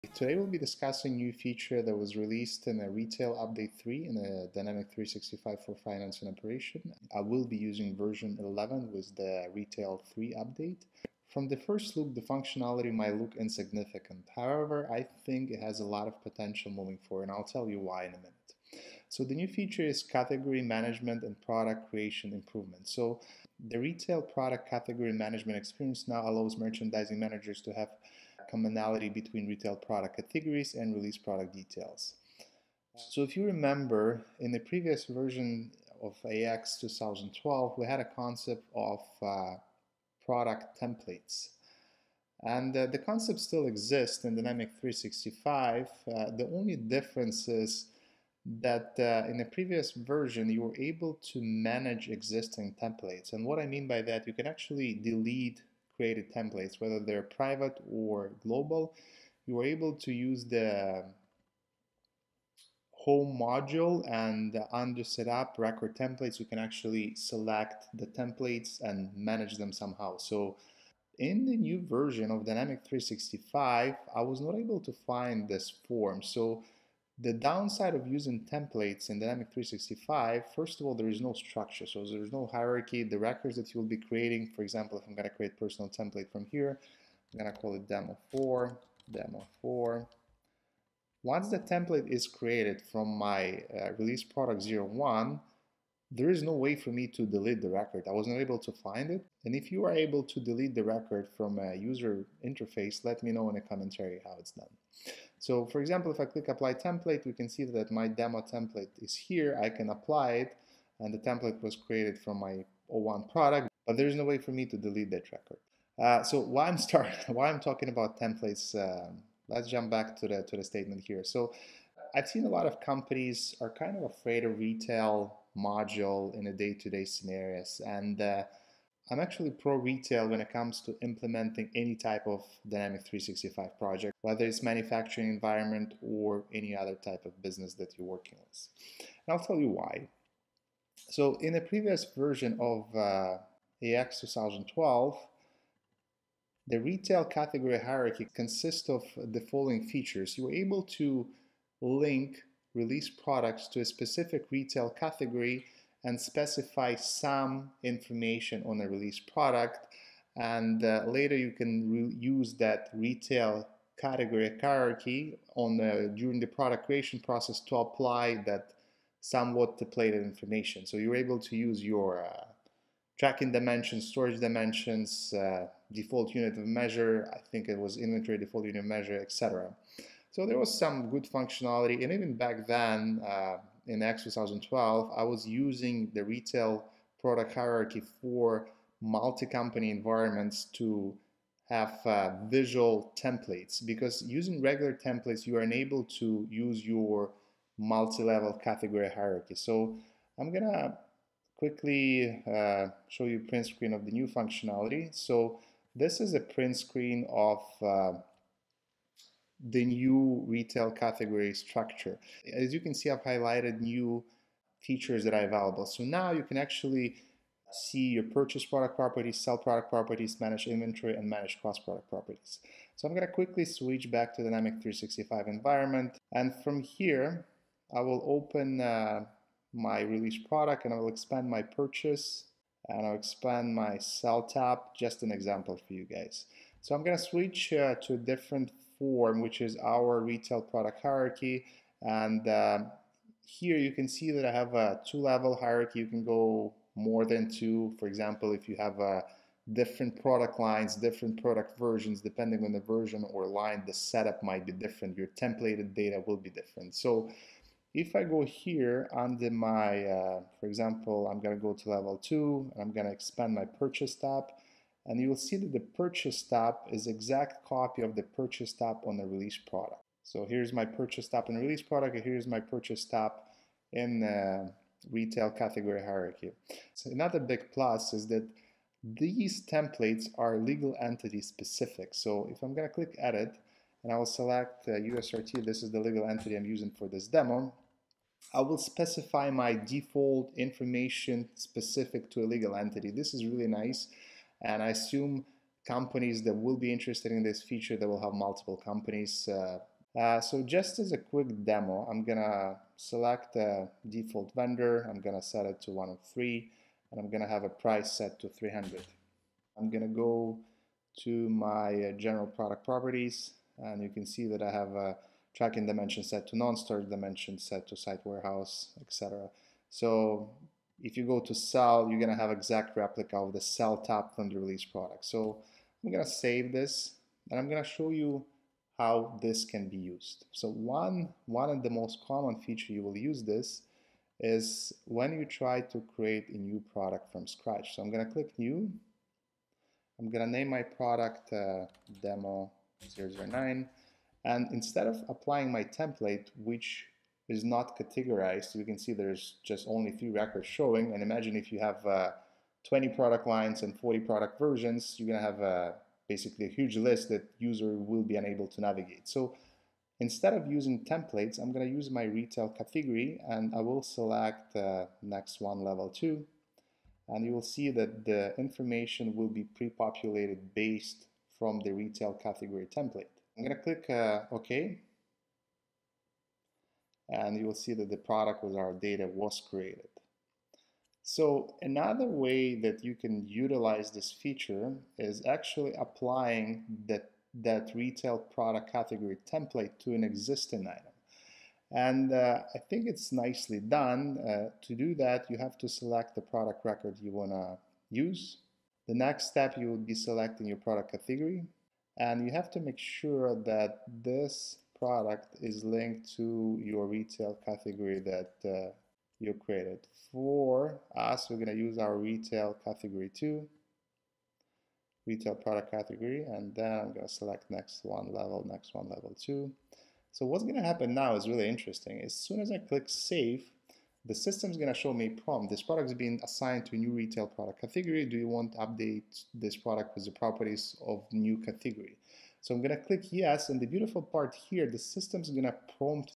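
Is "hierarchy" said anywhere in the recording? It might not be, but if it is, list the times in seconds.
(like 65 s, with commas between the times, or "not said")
82 s, 147 s, 164 s, 187 s, 199 s, 241 s, 245 s, 276 s.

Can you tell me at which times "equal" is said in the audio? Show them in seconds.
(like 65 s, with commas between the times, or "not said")
not said.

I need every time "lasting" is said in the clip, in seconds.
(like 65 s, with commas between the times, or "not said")
not said.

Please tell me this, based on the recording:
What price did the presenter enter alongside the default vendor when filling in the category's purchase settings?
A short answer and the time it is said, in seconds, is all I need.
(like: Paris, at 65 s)
300, at 308 s.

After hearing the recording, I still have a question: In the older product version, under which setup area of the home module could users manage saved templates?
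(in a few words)
record templates.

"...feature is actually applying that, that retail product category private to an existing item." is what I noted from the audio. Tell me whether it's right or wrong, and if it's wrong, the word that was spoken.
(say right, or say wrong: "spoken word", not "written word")
wrong: "template", not "private".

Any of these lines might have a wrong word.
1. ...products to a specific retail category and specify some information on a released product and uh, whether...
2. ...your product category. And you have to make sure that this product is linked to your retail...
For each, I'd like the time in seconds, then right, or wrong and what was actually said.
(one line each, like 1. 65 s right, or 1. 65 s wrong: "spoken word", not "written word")
1. 153 s wrong: "later", not "whether"
2. 400 s right.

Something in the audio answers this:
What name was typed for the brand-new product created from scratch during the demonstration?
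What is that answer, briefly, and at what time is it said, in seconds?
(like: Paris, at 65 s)
demo 009, at 342 s.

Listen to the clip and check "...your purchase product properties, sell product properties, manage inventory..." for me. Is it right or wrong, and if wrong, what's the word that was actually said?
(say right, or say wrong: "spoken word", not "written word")
right.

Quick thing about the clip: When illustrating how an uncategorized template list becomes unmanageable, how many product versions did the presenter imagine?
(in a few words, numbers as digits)
40.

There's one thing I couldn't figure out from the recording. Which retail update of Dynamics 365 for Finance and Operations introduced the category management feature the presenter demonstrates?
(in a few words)
Retail Update 3.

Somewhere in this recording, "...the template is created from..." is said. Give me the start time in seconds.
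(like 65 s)
91 s.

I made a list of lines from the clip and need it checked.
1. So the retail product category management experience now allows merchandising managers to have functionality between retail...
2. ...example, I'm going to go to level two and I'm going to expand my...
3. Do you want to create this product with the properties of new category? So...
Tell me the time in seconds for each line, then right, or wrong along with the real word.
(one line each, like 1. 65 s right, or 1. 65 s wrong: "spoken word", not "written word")
1. 22 s wrong: "commonality", not "functionality"
2. 260 s right
3. 428 s wrong: "update", not "create".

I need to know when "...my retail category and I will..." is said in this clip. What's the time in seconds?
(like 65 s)
362 s.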